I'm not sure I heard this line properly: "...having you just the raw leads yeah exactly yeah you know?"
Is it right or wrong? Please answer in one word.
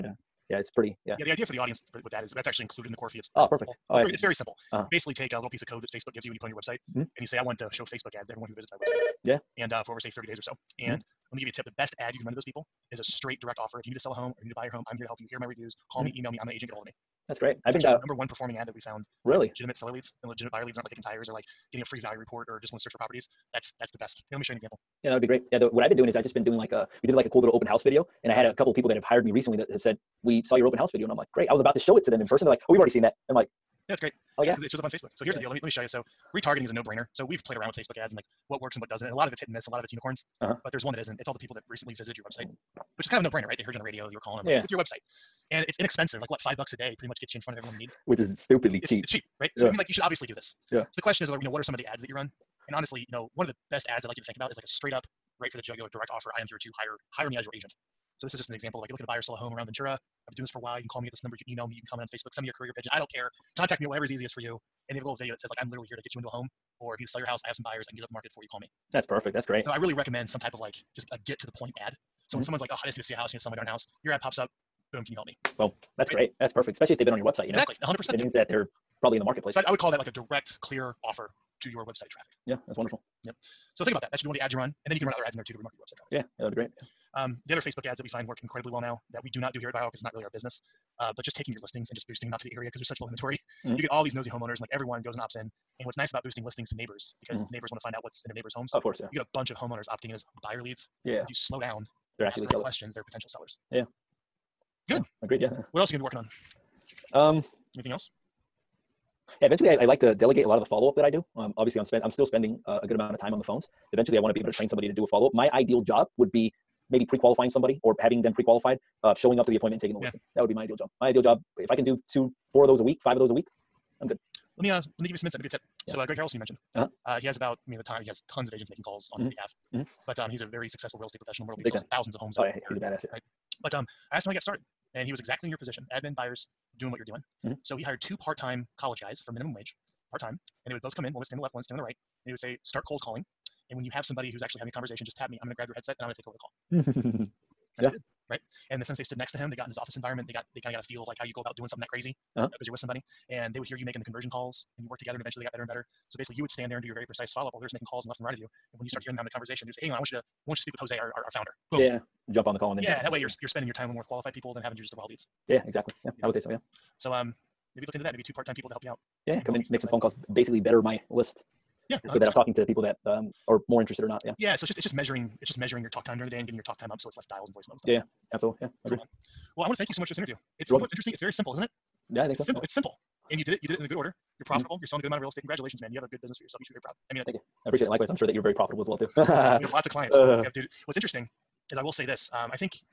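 right.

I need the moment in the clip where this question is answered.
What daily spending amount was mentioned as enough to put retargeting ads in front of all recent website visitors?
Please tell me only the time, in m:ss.
0:46.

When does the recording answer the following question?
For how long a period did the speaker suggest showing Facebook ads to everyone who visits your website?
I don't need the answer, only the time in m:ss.
0:10.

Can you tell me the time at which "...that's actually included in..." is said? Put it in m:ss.
0:02.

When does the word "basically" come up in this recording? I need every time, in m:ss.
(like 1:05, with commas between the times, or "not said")
0:04, 2:36, 2:50.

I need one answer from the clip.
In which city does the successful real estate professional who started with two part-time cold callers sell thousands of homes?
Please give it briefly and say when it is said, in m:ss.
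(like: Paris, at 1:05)
Myrtle Beach, at 2:11.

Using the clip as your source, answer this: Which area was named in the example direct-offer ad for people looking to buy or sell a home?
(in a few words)
Ventura.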